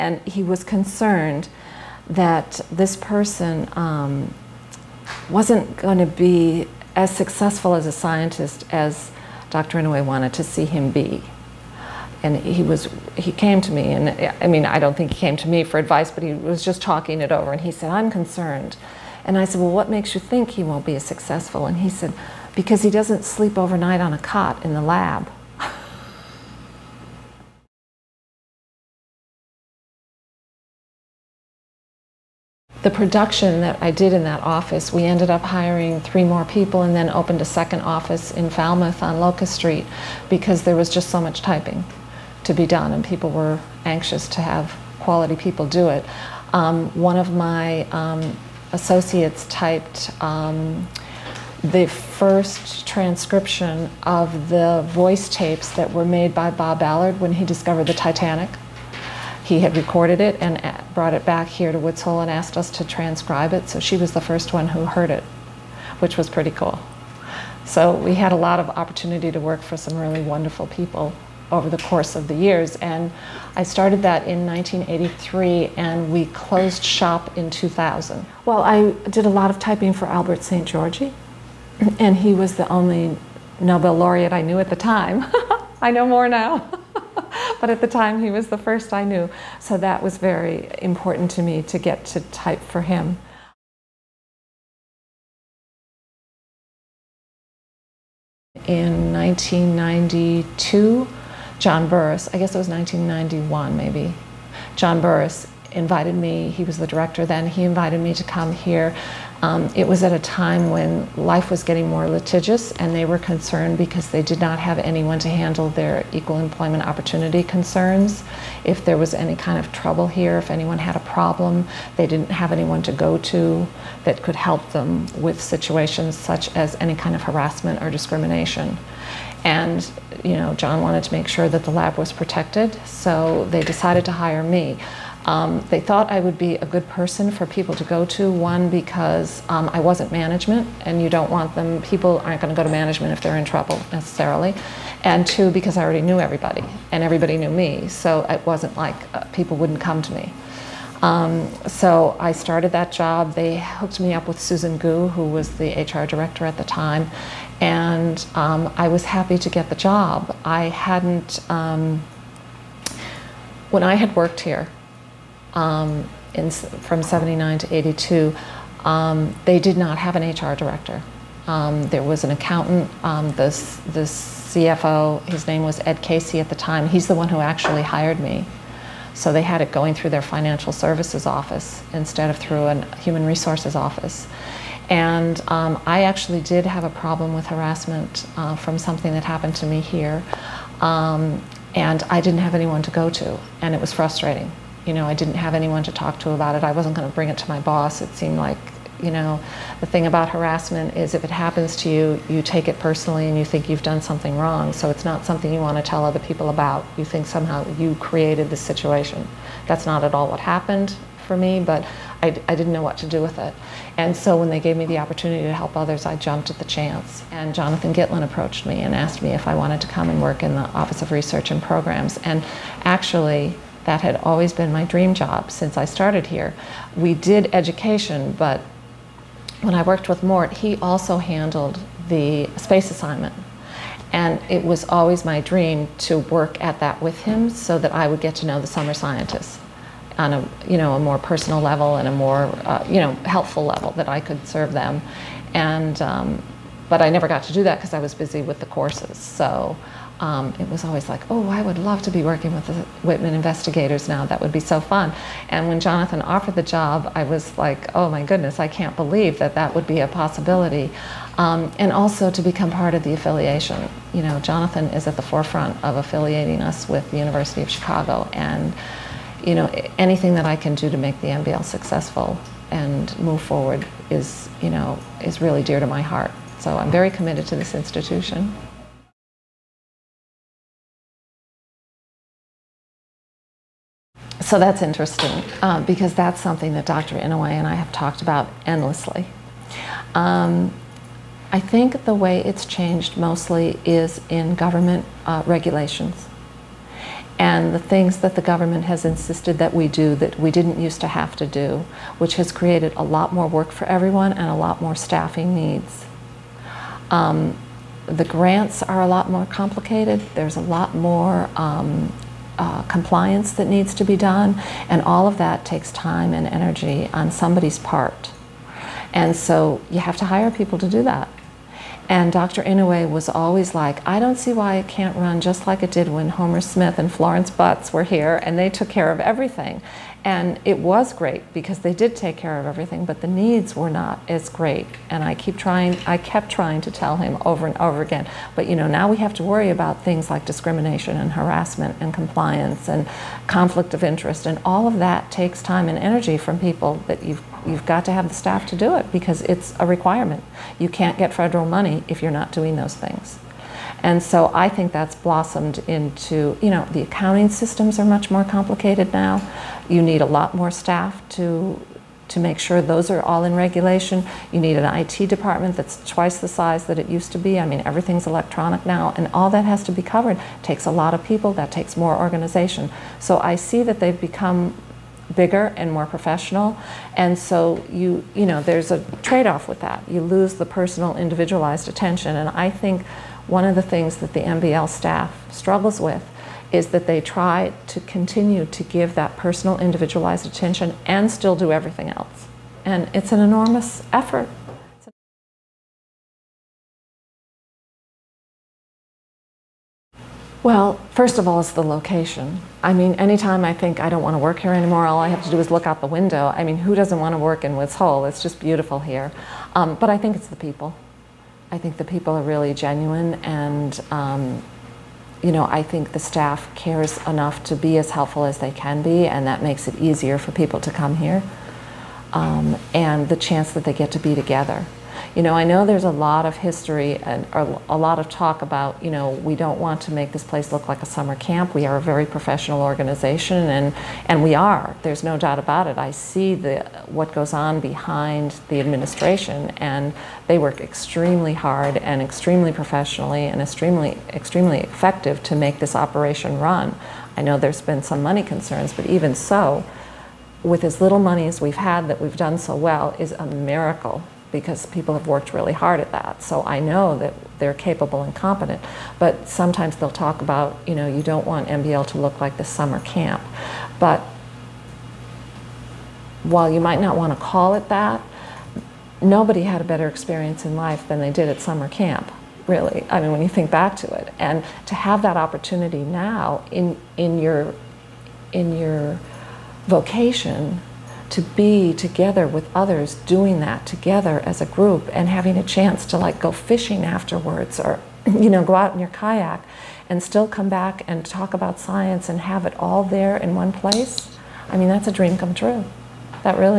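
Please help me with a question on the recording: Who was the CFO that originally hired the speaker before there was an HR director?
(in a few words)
Ed Casey.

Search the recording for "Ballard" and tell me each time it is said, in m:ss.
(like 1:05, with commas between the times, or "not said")
0:56.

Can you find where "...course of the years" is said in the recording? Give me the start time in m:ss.
1:11.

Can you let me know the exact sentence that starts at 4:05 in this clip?
And, um, but I never got to do that because I was busy with the courses.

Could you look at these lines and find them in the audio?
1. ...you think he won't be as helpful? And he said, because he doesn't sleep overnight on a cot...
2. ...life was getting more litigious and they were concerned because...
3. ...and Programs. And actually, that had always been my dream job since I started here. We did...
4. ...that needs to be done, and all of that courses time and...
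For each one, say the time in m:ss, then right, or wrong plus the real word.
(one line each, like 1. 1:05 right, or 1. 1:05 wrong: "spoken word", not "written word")
1. 0:20 wrong: "successful", not "helpful"
2. 1:51 right
3. 3:41 right
4. 5:13 wrong: "takes", not "courses".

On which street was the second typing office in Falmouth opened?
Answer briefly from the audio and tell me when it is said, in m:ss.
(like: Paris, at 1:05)
Locust Street, at 0:39.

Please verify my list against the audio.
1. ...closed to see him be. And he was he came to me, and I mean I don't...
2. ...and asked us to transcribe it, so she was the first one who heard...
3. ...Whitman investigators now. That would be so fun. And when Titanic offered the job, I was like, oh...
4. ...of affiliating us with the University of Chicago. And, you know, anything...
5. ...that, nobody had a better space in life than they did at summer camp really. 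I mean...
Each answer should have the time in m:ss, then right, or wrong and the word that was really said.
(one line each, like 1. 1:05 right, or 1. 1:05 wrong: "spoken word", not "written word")
1. 0:10 wrong: "wanted", not "closed"
2. 1:02 right
3. 4:13 wrong: "Jonathan", not "Titanic"
4. 4:25 right
5. 7:47 wrong: "experience", not "space".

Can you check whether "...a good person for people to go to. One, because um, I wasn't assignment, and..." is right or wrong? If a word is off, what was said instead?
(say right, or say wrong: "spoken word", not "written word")
wrong: "management", not "assignment".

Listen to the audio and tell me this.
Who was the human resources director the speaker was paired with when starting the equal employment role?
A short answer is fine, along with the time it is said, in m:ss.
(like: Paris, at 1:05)
Susan Gu, at 2:34.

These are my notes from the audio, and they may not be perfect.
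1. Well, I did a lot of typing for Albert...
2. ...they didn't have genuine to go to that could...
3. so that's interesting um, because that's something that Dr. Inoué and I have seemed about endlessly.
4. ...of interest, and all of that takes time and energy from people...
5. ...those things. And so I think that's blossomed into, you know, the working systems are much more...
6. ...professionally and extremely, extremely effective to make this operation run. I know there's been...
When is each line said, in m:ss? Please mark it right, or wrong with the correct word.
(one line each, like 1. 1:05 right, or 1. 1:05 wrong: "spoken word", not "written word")
1. 1:18 right
2. 2:01 wrong: "anyone", not "genuine"
3. 4:44 wrong: "talked", not "seemed"
4. 5:43 right
5. 5:52 wrong: "accounting", not "working"
6. 7:22 right.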